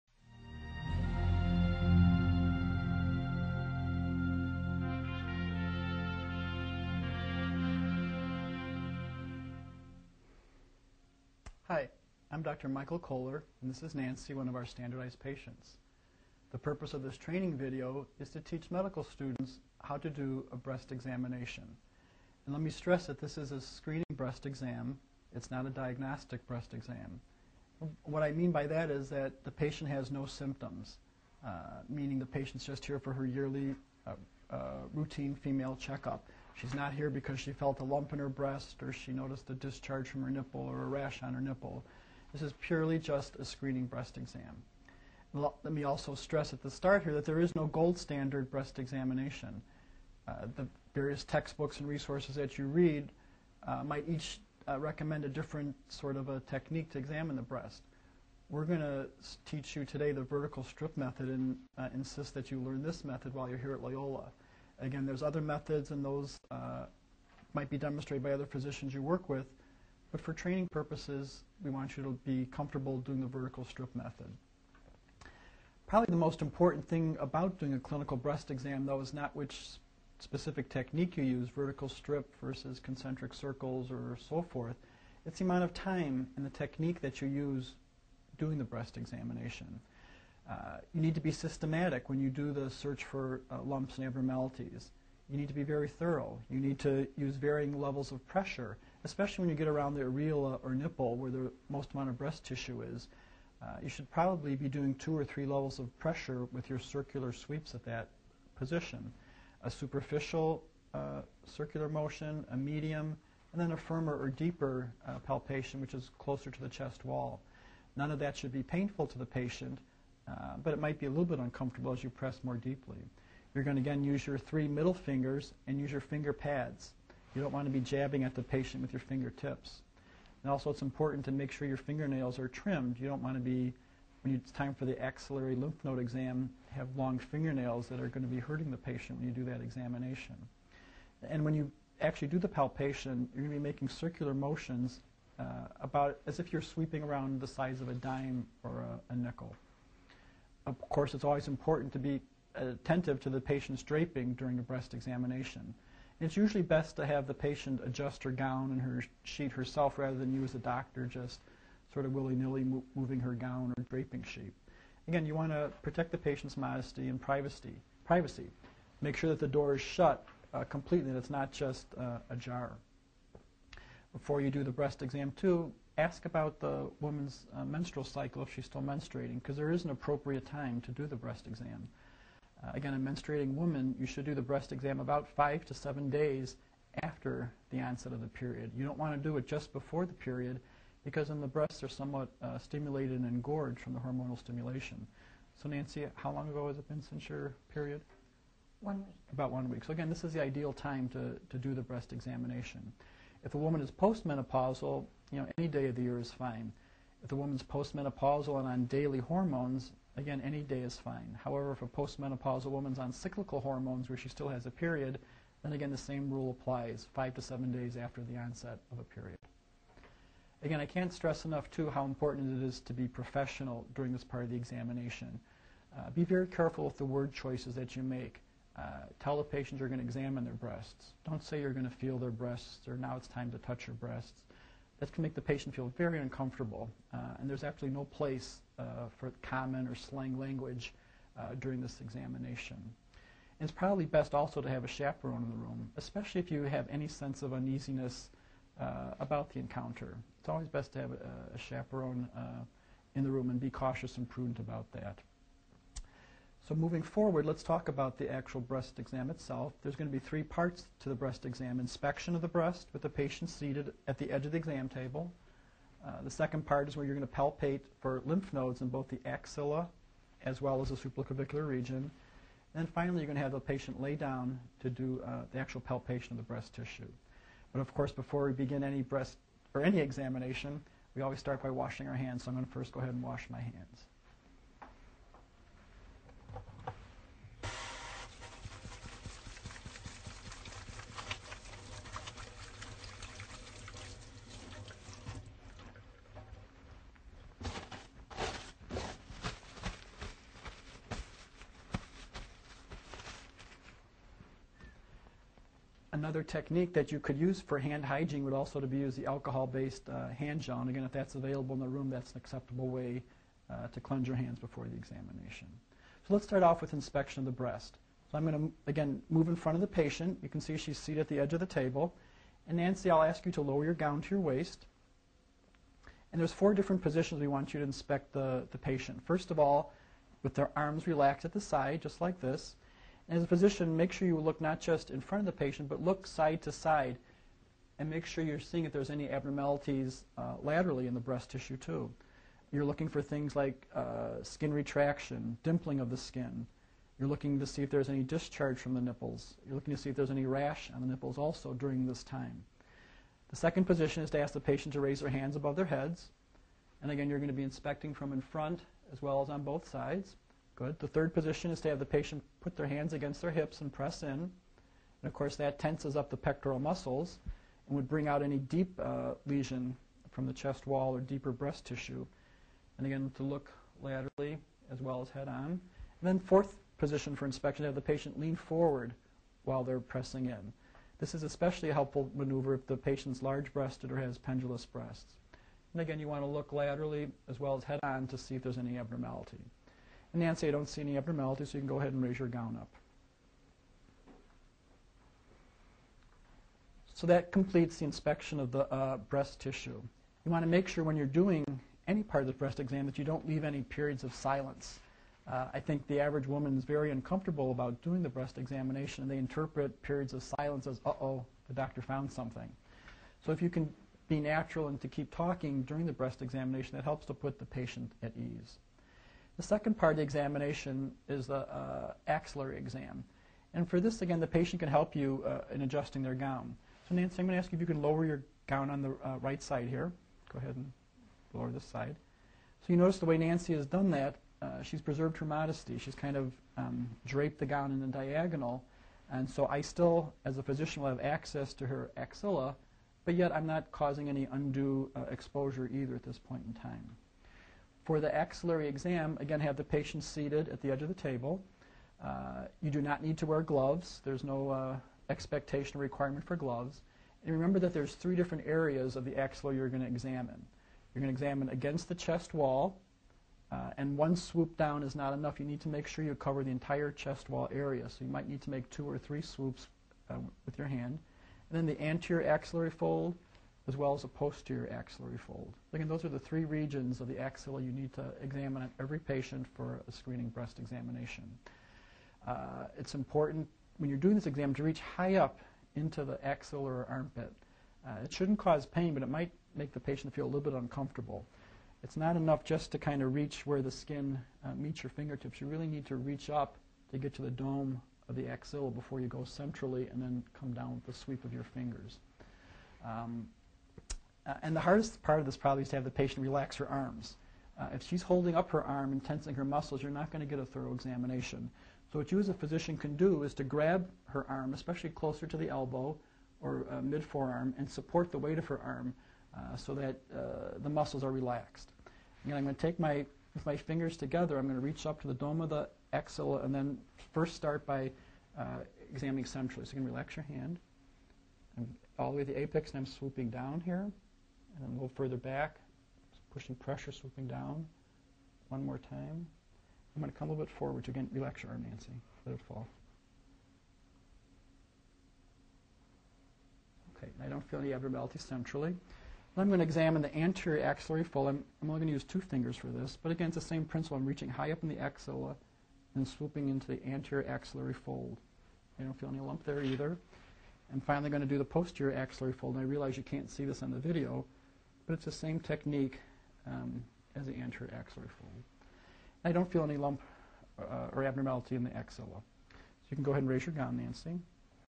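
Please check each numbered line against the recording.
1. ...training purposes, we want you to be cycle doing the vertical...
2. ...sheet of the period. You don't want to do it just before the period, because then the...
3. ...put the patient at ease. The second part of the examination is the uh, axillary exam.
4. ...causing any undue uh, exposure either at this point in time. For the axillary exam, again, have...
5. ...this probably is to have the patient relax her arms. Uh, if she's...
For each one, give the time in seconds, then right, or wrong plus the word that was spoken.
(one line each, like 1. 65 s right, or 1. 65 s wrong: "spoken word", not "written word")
1. 70 s wrong: "comfortable", not "cycle"
2. 187 s wrong: "onset", not "sheet"
3. 417 s right
4. 443 s right
5. 505 s right.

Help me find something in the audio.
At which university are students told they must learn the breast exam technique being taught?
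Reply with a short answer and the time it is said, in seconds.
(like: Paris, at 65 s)
Loyola, at 63 s.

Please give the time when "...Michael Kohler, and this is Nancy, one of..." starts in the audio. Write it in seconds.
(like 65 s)
12 s.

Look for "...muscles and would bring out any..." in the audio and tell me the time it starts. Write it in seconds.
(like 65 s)
366 s.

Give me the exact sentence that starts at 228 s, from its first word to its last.
Uh, tell the patient you're going to examine their breasts.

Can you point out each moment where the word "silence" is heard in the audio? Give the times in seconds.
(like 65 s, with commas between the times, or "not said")
404 s, 410 s.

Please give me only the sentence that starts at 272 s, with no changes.
And finally, you're going to have the patient lay down to do uh, the actual palpation of the breast tissue.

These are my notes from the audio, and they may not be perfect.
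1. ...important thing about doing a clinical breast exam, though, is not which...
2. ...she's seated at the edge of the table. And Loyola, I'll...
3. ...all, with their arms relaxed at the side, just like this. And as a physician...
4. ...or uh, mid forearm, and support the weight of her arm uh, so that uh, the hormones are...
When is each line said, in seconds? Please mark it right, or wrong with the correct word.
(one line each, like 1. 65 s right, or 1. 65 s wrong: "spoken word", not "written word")
1. 76 s right
2. 320 s wrong: "Nancy", not "Loyola"
3. 329 s right
4. 516 s wrong: "muscles", not "hormones".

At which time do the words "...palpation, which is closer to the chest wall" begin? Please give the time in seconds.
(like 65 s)
115 s.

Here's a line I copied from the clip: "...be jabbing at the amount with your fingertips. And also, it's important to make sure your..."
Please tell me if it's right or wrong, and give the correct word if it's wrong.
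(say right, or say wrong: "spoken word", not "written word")
wrong: "patient", not "amount".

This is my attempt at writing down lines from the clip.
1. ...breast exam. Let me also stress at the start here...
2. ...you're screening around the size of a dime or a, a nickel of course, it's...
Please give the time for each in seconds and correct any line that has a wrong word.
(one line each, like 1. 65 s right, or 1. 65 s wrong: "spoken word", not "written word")
1. 43 s right
2. 146 s wrong: "sweeping", not "screening".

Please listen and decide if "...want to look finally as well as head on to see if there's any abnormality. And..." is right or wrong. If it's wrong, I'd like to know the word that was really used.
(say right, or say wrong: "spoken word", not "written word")
wrong: "laterally", not "finally".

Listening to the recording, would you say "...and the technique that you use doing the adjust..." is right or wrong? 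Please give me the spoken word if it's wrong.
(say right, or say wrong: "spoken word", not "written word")
wrong: "breast", not "adjust".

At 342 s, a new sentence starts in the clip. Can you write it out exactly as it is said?
You're looking for things like uh, skin retraction, dimpling of the skin.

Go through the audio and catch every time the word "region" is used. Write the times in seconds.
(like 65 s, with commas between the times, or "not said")
271 s, 476 s.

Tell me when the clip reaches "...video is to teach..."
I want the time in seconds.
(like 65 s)
17 s.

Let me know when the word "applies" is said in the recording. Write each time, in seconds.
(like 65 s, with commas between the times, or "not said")
216 s.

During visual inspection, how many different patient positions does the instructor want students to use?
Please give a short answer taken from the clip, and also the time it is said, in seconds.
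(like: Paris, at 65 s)
four, at 326 s.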